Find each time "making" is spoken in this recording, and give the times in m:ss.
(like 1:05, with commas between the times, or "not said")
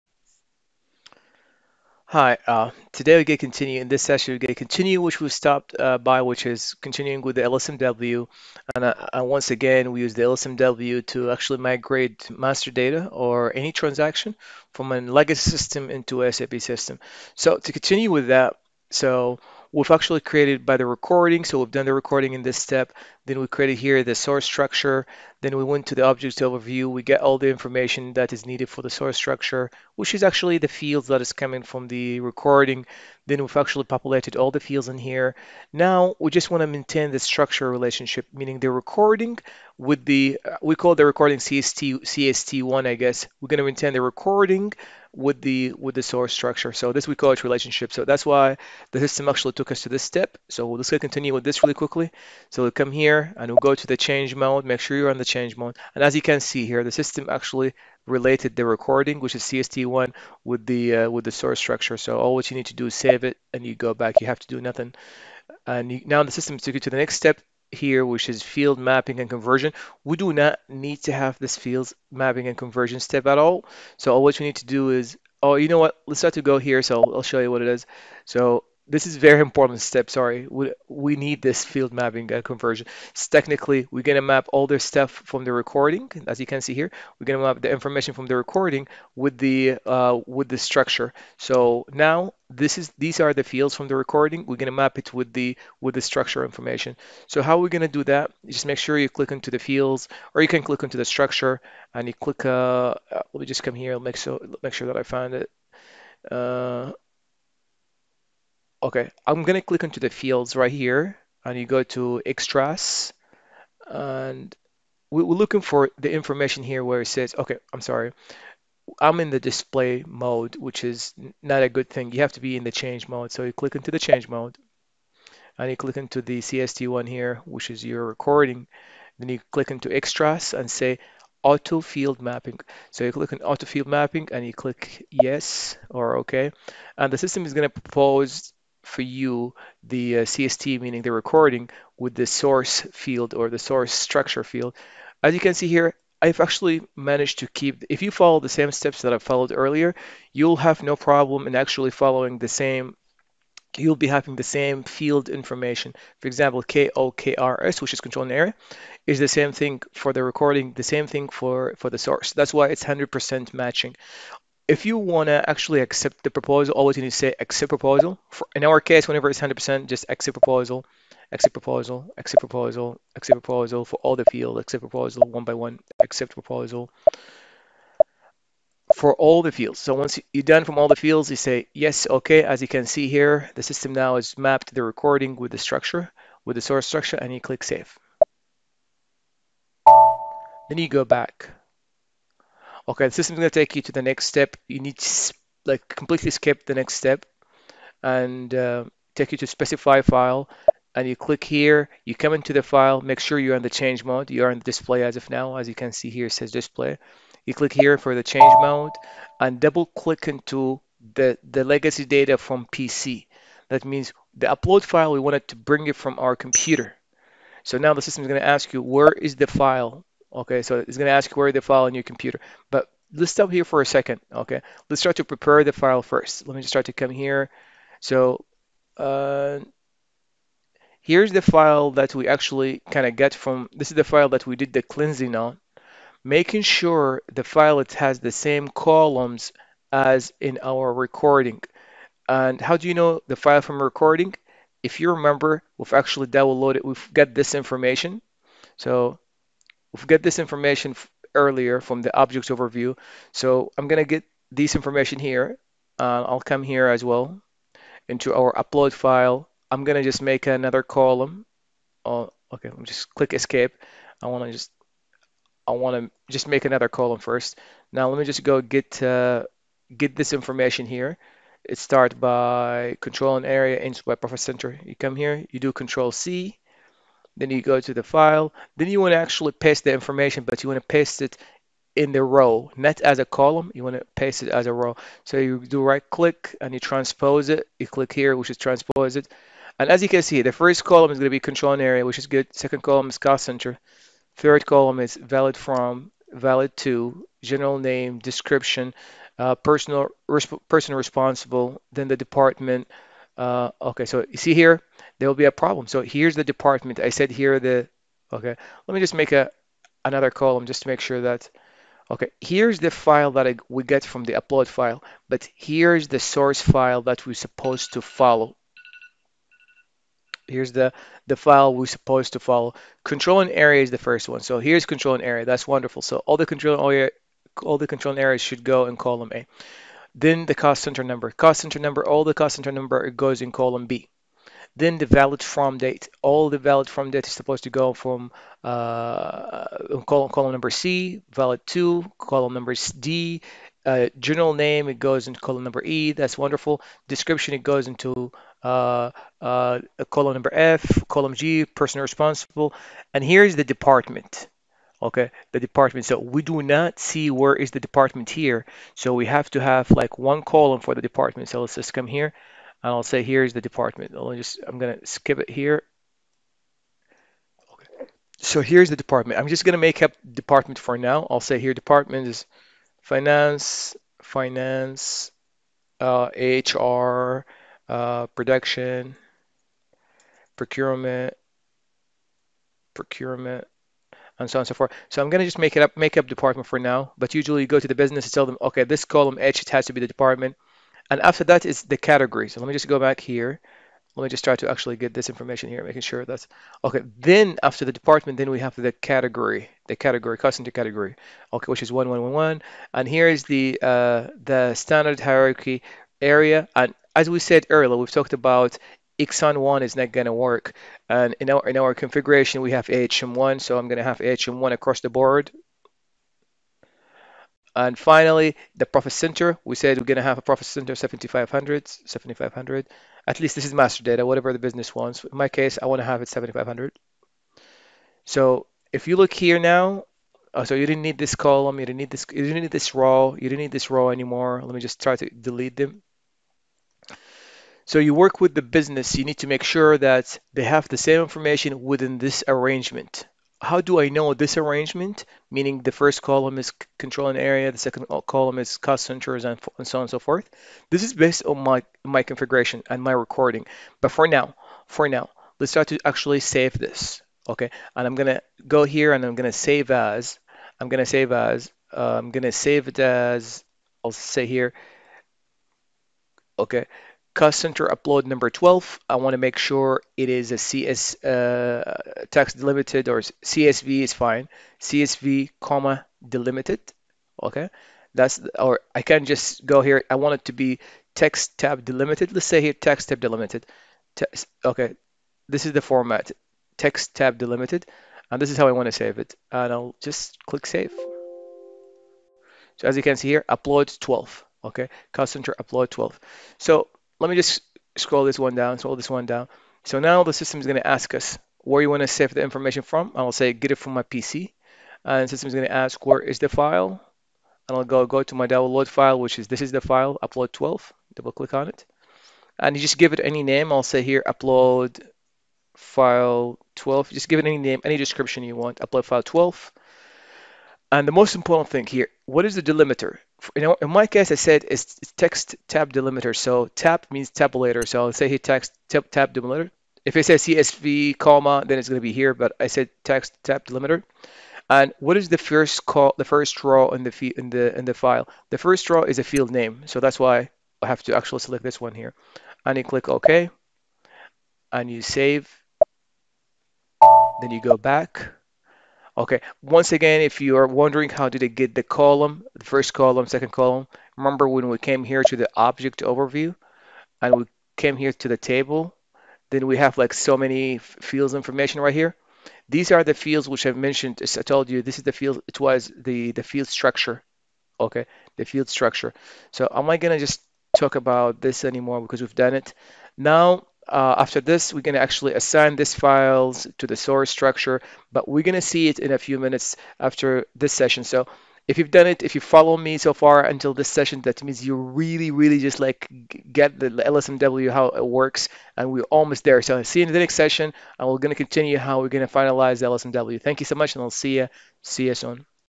3:56, 6:35.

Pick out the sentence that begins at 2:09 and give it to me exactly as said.
Then you click into extras and say auto field mapping.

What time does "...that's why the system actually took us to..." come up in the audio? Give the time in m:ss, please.
0:48.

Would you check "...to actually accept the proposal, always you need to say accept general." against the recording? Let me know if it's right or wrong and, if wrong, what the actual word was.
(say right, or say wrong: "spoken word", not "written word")
wrong: "proposal", not "general".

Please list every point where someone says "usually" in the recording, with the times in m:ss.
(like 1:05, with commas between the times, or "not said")
6:27.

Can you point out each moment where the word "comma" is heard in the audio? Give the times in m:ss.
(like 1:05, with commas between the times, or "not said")
7:55, 8:51.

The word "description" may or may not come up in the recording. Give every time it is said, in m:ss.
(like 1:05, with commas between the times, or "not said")
4:58, 5:47, 8:37.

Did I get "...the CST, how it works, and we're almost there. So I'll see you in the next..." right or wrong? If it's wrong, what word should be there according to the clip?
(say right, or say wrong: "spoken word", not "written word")
wrong: "LSMW", not "CST".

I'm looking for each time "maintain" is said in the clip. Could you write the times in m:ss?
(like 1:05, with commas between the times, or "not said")
0:36, 0:43.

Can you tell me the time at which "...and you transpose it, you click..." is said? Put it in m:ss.
4:46.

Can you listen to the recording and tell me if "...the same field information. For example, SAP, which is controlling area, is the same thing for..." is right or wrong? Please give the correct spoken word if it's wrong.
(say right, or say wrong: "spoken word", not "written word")
wrong: "KOKRS", not "SAP".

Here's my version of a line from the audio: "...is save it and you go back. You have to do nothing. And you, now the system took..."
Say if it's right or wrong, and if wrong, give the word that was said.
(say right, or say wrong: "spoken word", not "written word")
right.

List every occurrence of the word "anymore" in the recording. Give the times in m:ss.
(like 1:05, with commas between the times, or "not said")
7:14, 9:31.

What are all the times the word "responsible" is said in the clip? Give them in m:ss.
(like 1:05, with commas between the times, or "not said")
5:00, 5:52.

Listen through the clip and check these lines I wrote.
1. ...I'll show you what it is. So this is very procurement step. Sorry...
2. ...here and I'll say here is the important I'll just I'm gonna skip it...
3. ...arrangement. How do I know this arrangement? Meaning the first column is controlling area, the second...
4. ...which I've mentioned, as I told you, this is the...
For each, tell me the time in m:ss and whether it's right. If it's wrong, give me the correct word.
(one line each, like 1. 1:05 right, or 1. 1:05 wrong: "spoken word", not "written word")
1. 1:17 wrong: "important", not "procurement"
2. 6:02 wrong: "department", not "important"
3. 7:22 right
4. 9:23 right.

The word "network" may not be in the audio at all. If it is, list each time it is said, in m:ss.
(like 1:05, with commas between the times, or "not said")
not said.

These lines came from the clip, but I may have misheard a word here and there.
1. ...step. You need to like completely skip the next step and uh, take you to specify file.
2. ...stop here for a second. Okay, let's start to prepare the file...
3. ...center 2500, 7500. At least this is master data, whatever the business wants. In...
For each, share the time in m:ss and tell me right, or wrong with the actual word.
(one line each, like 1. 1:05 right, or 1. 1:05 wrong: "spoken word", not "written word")
1. 3:14 right
2. 3:43 right
3. 7:00 wrong: "7500", not "2500".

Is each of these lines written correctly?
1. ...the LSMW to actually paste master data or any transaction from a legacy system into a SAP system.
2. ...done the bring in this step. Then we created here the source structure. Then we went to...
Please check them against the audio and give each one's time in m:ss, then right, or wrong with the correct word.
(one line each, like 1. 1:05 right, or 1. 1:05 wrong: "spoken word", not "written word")
1. 0:10 wrong: "migrate", not "paste"
2. 0:21 wrong: "recording", not "bring".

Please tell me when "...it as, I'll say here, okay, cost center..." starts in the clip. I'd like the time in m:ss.
7:42.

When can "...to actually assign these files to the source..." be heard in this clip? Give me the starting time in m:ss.
9:34.